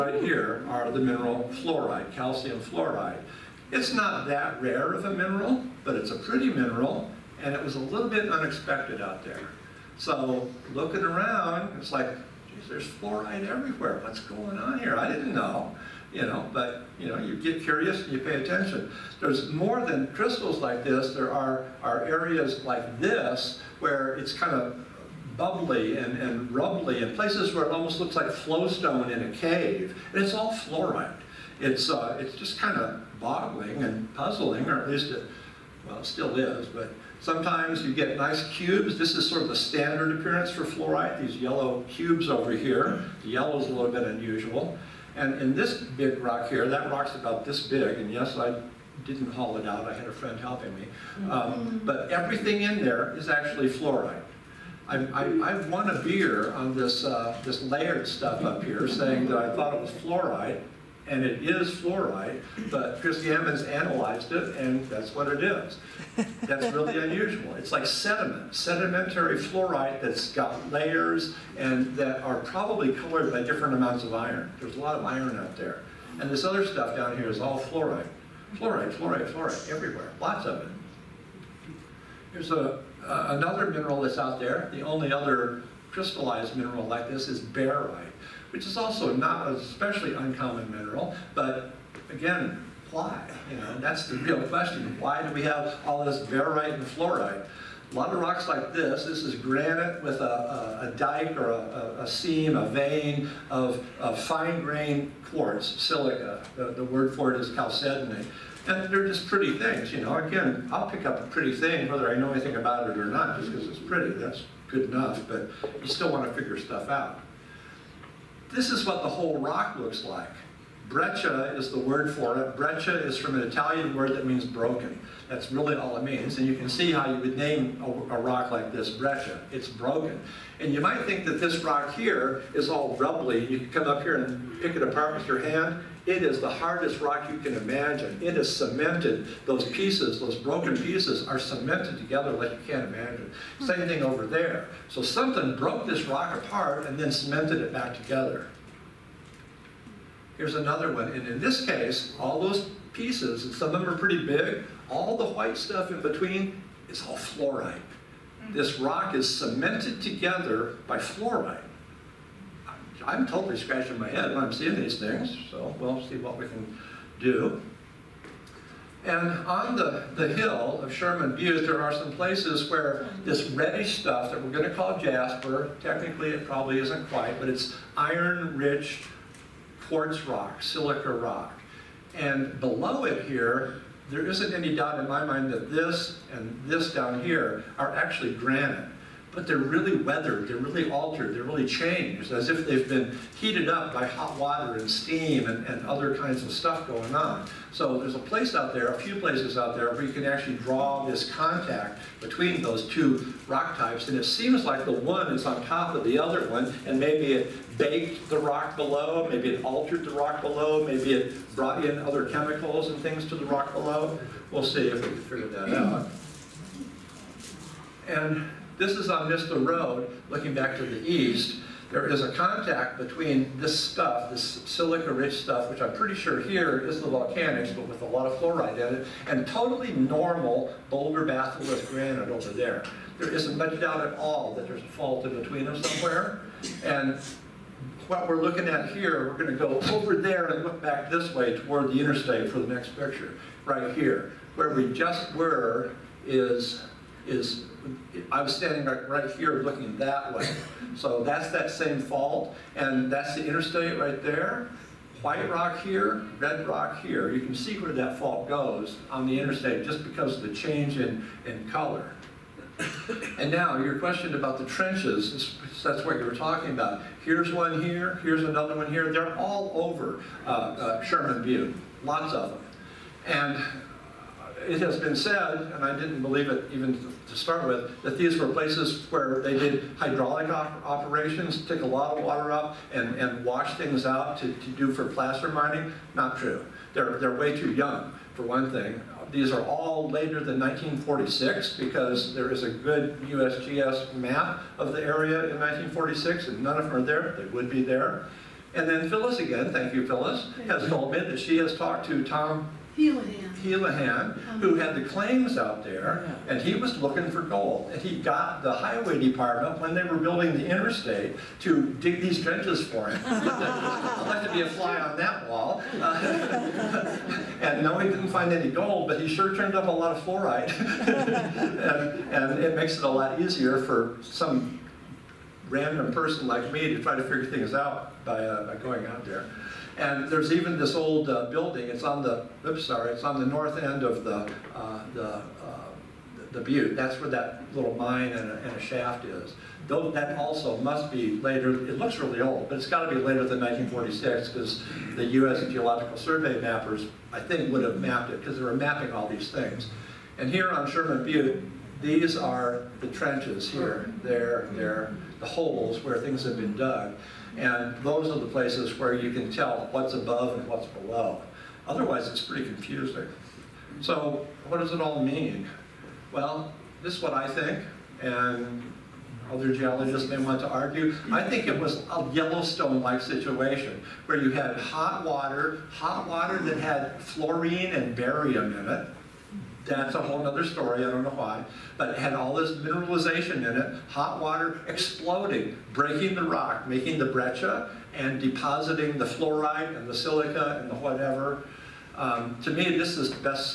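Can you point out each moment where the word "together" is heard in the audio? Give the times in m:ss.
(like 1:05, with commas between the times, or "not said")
2:21, 2:27, 2:40.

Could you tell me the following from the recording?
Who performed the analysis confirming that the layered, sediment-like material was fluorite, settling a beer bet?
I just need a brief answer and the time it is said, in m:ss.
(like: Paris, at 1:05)
Christy Evans, at 1:03.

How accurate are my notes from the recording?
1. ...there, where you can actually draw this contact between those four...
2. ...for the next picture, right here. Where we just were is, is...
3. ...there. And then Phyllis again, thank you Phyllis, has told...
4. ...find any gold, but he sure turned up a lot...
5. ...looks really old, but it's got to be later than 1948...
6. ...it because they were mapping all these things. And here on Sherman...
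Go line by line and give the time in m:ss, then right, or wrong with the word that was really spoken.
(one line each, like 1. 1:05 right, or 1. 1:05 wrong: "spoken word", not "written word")
1. 3:19 wrong: "two", not "four"
2. 4:02 right
3. 4:57 right
4. 5:18 right
5. 5:41 wrong: "1946", not "1948"
6. 5:48 right.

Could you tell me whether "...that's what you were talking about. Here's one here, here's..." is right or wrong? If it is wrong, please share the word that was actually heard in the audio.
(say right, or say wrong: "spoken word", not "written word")
right.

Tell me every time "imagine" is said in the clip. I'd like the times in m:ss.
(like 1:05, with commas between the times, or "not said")
2:17, 2:22.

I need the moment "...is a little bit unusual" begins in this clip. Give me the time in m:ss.
0:43.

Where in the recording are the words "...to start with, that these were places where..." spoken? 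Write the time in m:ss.
4:37.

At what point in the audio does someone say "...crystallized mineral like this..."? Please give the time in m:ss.
1:25.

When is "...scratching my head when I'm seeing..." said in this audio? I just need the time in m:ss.
2:43.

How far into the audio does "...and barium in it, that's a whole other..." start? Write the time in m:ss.
6:17.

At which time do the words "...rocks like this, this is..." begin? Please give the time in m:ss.
1:38.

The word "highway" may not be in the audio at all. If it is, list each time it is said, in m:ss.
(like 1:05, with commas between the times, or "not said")
5:08.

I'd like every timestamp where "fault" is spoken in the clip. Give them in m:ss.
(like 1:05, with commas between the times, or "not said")
3:54, 4:11, 4:18.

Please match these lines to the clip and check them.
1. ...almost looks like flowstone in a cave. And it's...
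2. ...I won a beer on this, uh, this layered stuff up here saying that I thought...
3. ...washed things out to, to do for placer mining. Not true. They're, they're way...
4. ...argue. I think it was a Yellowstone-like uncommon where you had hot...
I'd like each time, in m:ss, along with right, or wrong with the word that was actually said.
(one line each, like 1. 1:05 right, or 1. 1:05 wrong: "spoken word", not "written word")
1. 0:27 right
2. 0:55 right
3. 4:43 right
4. 6:10 wrong: "situation", not "uncommon".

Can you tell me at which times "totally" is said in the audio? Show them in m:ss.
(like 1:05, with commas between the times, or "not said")
2:43, 3:49.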